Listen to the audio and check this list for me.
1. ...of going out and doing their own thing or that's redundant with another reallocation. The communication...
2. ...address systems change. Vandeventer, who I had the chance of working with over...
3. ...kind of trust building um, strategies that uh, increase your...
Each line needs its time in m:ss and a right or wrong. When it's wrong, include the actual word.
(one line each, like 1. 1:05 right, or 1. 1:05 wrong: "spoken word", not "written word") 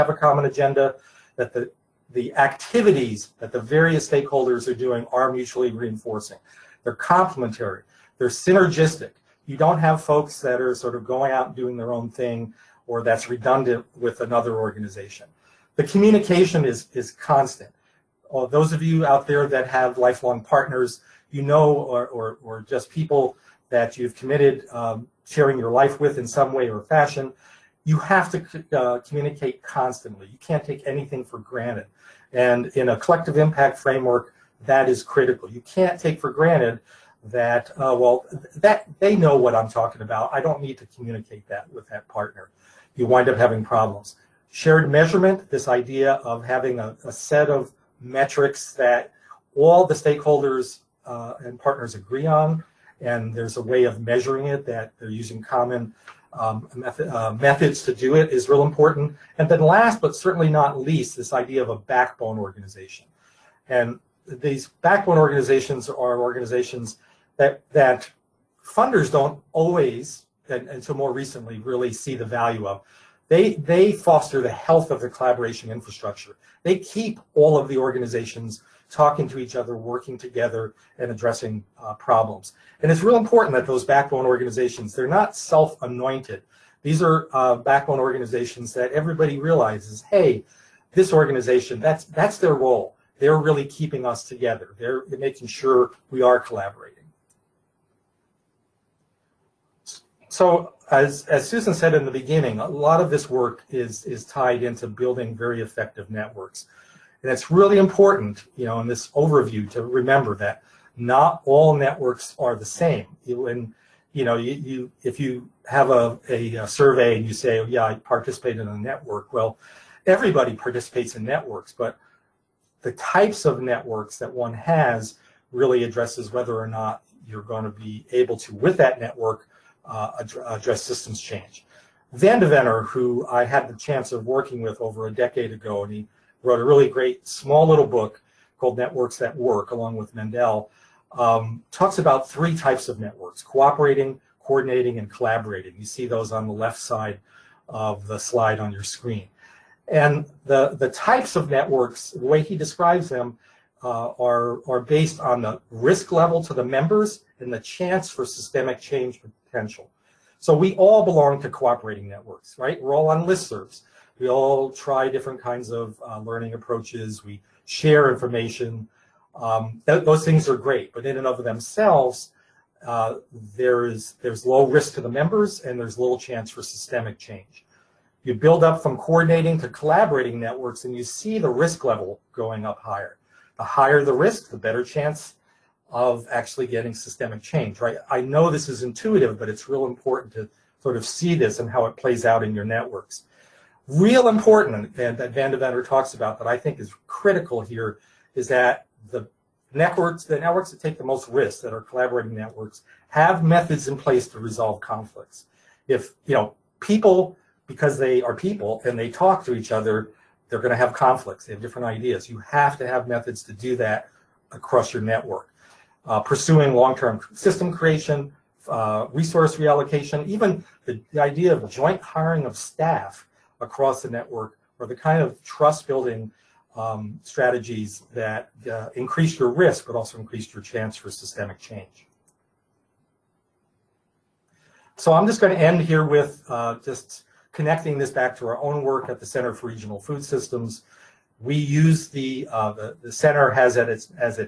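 1. 0:10 wrong: "organization", not "reallocation"
2. 2:10 right
3. 3:44 right.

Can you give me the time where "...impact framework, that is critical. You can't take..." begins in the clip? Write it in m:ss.
0:33.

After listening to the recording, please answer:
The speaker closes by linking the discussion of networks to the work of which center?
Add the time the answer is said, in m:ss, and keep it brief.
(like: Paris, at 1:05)
Center for Regional Food Systems, at 3:59.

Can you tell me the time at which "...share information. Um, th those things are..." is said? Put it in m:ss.
2:47.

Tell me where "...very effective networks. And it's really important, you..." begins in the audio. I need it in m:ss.
1:45.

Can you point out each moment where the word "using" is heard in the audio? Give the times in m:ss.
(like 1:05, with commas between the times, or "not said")
0:55.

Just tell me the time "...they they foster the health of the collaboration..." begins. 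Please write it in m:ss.
1:13.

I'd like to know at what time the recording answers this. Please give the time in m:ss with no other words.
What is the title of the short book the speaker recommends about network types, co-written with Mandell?
2:18.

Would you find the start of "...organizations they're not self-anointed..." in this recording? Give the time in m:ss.
1:24.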